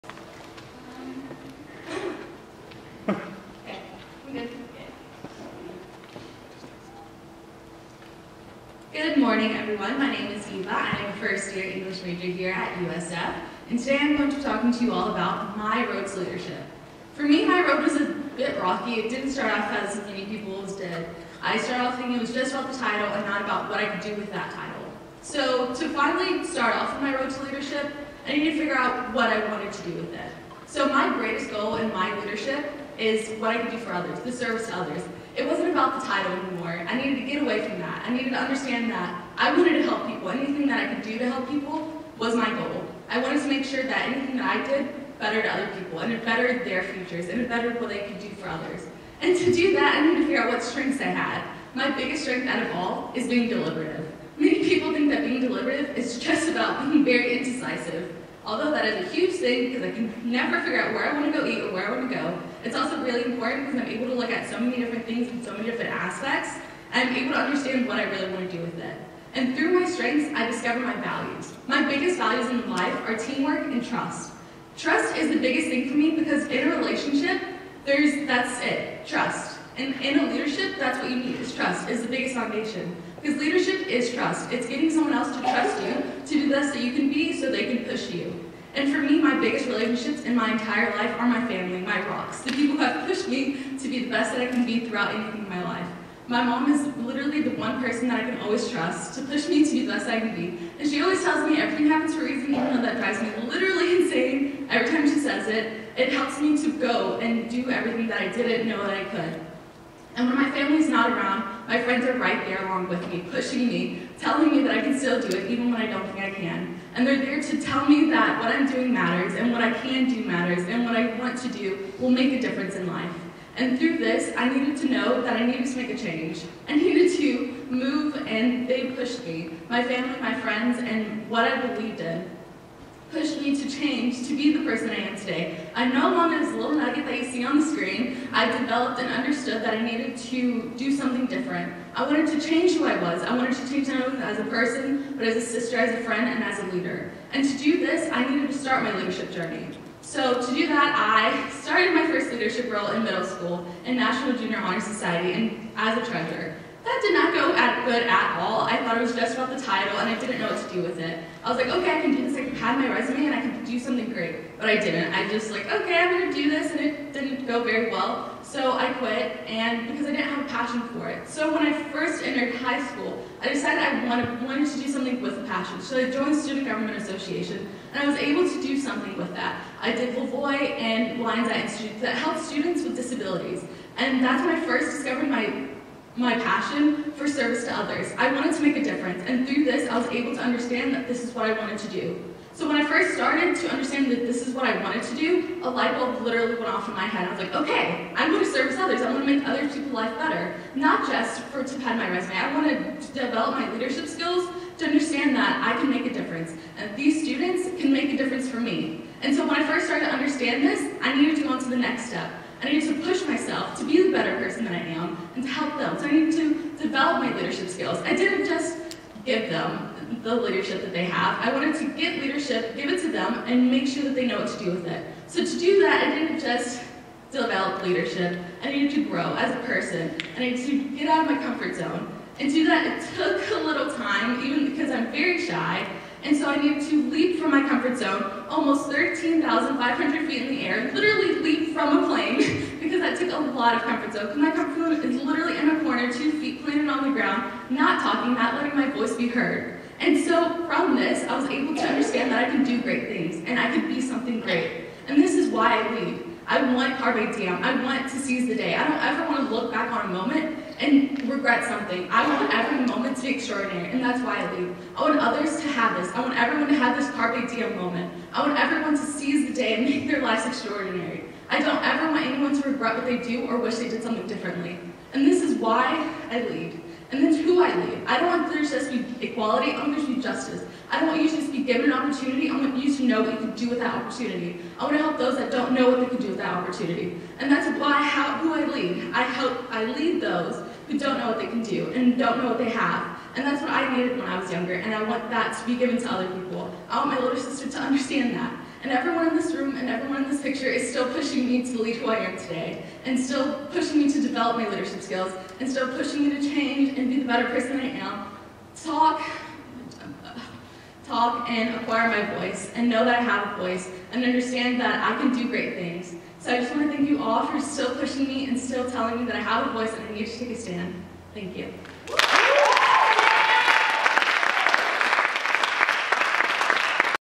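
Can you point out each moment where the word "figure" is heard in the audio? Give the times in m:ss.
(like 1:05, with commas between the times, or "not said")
0:28, 0:50, 1:00.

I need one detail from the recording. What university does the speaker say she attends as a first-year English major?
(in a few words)
USF.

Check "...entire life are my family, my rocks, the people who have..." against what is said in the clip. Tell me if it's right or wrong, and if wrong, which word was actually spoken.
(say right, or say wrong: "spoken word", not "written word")
right.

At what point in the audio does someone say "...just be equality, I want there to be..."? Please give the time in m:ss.
4:38.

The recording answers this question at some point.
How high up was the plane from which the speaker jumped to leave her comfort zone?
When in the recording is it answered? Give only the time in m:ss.
3:58.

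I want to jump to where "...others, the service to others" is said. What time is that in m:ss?
0:33.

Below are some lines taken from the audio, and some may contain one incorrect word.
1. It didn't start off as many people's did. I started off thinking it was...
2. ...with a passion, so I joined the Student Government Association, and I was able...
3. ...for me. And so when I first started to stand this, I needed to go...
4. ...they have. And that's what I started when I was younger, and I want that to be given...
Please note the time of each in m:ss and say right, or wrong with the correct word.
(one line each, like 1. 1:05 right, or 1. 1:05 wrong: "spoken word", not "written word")
1. 0:18 right
2. 2:55 right
3. 3:28 wrong: "understand", not "stand"
4. 4:52 wrong: "needed", not "started".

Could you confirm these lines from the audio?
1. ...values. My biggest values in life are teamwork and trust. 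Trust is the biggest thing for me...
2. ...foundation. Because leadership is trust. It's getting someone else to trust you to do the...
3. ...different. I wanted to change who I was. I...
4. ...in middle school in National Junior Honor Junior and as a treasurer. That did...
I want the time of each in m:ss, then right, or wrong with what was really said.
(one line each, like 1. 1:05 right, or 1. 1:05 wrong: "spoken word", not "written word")
1. 1:10 right
2. 1:22 right
3. 2:21 right
4. 2:32 wrong: "Society", not "Junior".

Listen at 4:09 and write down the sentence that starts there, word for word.
And so from this, I was able to understand that I can do great things and I can be something great.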